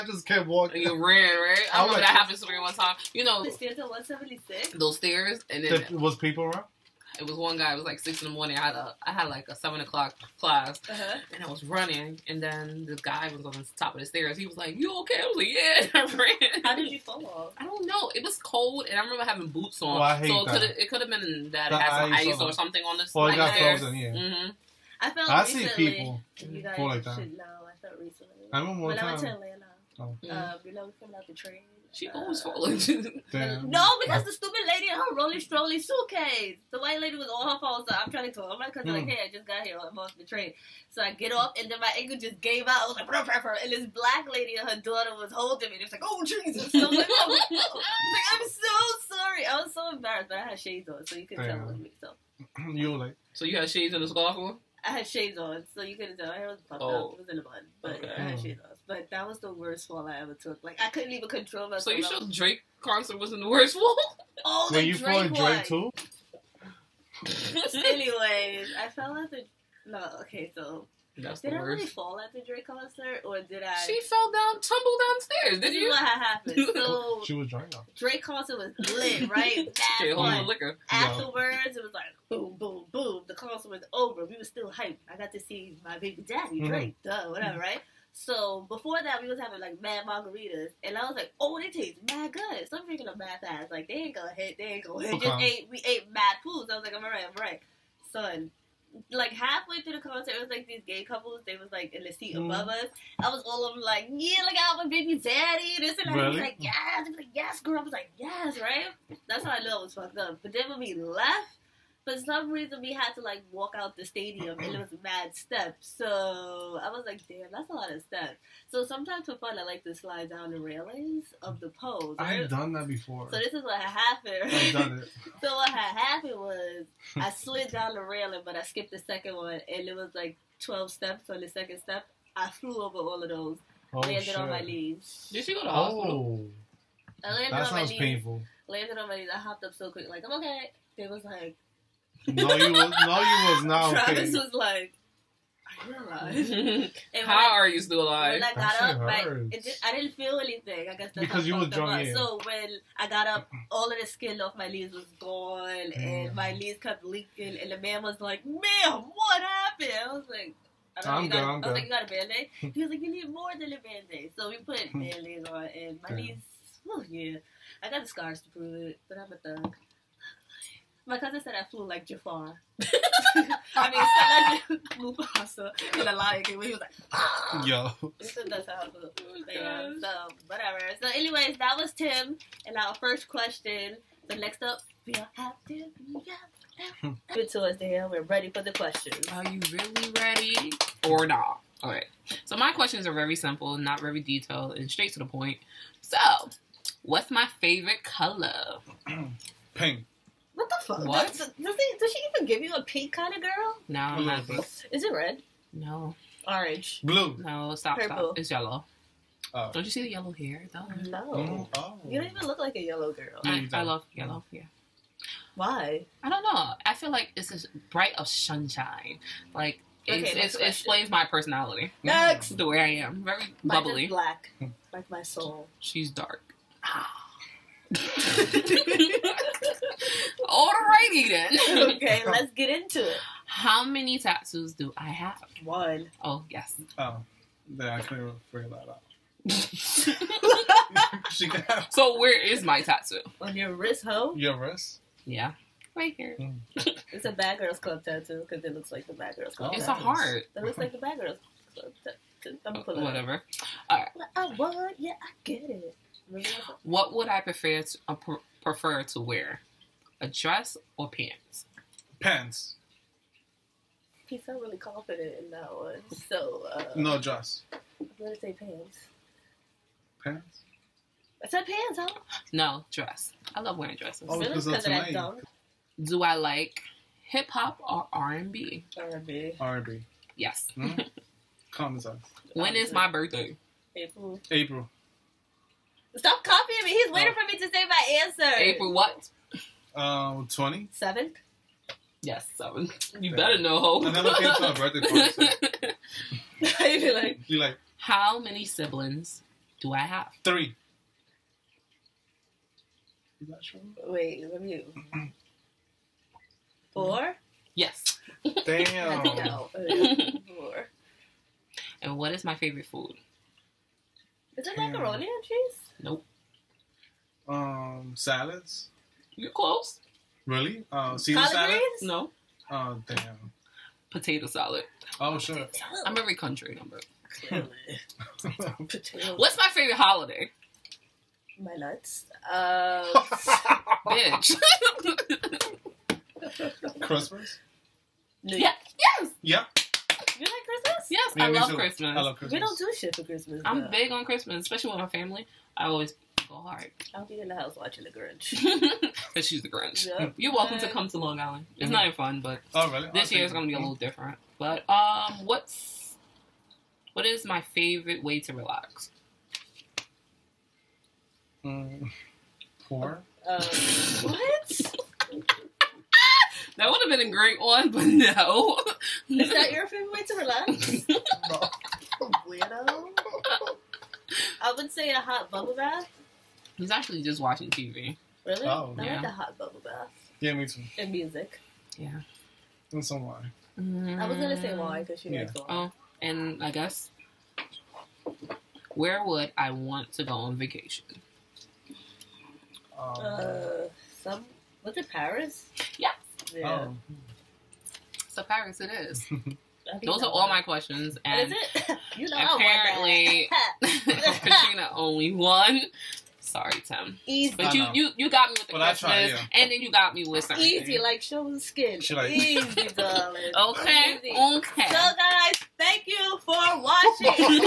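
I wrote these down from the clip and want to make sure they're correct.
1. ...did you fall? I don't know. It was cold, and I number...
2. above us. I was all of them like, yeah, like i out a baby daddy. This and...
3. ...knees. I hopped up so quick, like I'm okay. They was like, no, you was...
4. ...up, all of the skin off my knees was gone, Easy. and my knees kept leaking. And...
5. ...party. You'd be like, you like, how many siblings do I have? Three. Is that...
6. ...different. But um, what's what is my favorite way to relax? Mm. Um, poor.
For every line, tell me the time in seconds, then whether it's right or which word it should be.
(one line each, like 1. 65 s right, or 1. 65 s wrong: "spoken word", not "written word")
1. 16 s wrong: "remember", not "number"
2. 102 s right
3. 139 s right
4. 153 s wrong: "Damn", not "Easy"
5. 295 s right
6. 353 s right.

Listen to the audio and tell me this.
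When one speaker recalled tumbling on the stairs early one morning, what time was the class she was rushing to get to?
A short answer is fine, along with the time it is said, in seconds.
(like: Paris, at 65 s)
7 o'clock, at 9 s.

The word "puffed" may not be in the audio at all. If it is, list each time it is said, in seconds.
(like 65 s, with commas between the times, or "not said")
56 s.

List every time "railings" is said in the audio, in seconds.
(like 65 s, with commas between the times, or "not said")
120 s, 128 s.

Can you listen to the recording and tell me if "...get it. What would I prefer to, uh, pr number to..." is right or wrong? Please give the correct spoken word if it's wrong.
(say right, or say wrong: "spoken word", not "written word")
wrong: "prefer", not "number".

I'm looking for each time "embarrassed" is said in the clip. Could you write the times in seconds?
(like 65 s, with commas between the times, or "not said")
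49 s.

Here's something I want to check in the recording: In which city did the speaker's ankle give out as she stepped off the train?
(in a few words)
Atlanta.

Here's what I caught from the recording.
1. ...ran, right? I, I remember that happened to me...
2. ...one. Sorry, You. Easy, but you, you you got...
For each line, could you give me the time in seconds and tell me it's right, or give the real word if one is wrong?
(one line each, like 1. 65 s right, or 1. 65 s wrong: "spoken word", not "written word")
1. 1 s right
2. 405 s wrong: "Tim", not "You".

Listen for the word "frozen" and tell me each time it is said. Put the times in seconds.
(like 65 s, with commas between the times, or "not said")
23 s.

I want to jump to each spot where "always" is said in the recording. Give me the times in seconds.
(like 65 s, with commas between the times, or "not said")
32 s, 345 s.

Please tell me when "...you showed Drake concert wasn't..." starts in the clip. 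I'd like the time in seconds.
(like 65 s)
61 s.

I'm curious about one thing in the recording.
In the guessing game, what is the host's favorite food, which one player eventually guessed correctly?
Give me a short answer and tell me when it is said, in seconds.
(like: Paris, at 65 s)
Potato salad, at 324 s.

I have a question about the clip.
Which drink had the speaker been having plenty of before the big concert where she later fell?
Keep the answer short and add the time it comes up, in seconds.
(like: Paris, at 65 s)
Margaritas, at 90 s.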